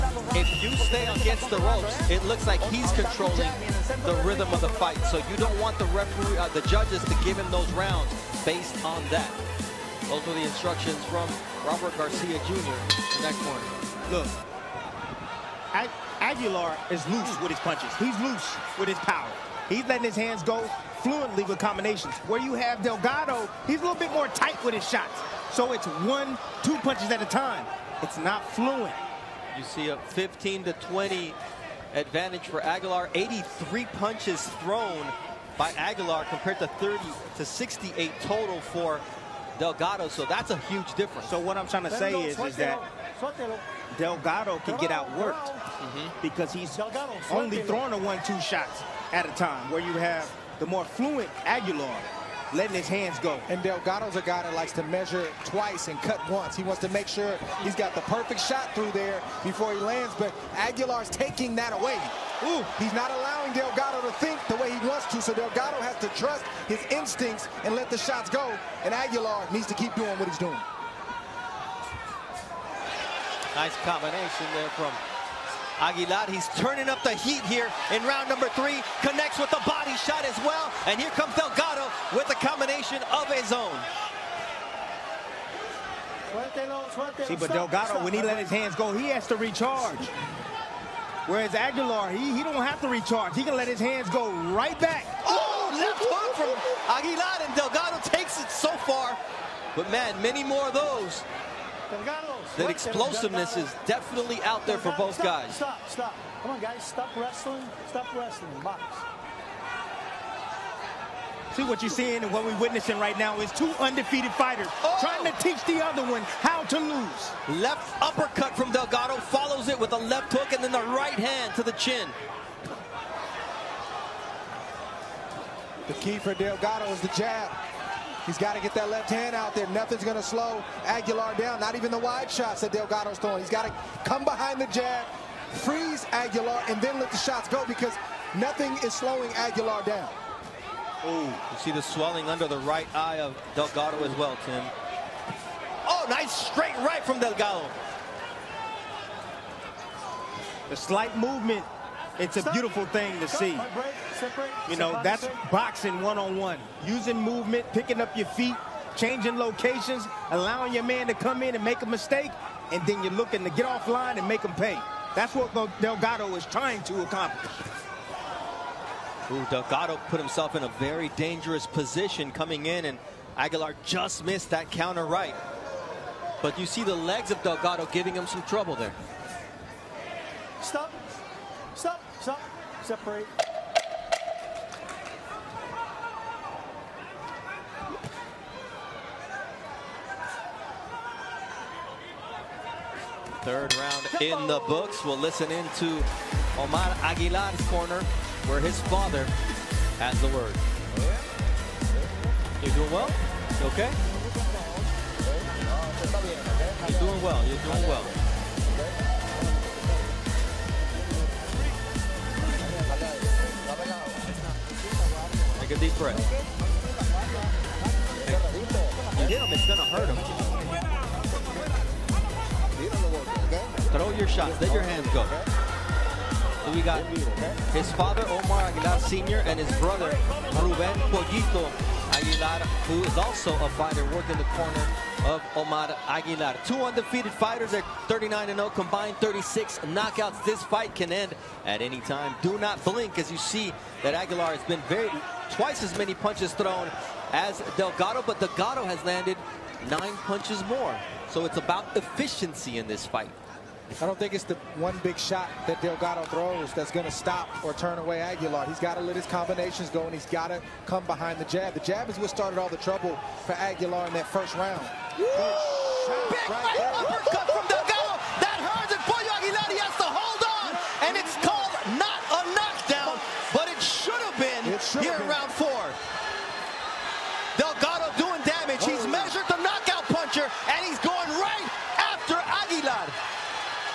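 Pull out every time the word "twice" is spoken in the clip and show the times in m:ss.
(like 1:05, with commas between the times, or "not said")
0:55, 4:05.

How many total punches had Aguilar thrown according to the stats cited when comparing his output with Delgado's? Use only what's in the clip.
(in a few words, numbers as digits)
83.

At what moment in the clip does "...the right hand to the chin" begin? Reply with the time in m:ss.
2:00.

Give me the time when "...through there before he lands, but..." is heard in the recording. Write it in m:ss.
0:58.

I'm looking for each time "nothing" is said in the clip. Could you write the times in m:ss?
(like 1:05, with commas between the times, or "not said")
2:09, 2:18.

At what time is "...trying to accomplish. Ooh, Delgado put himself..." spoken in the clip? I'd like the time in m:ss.
2:46.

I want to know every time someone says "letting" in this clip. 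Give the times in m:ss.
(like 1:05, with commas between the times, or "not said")
0:19, 0:52.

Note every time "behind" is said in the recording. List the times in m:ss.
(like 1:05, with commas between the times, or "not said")
2:14, 4:21.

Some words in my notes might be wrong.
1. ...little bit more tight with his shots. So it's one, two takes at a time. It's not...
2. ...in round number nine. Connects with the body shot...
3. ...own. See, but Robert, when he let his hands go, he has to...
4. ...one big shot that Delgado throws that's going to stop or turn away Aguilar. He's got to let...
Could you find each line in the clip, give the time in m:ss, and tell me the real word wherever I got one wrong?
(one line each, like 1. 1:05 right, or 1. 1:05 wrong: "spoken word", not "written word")
1. 0:23 wrong: "punches", not "takes"
2. 1:17 wrong: "three", not "nine"
3. 1:23 wrong: "Delgado", not "Robert"
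4. 4:14 right.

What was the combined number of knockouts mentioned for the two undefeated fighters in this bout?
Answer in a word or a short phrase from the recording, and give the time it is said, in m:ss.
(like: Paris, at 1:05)
36, at 3:59.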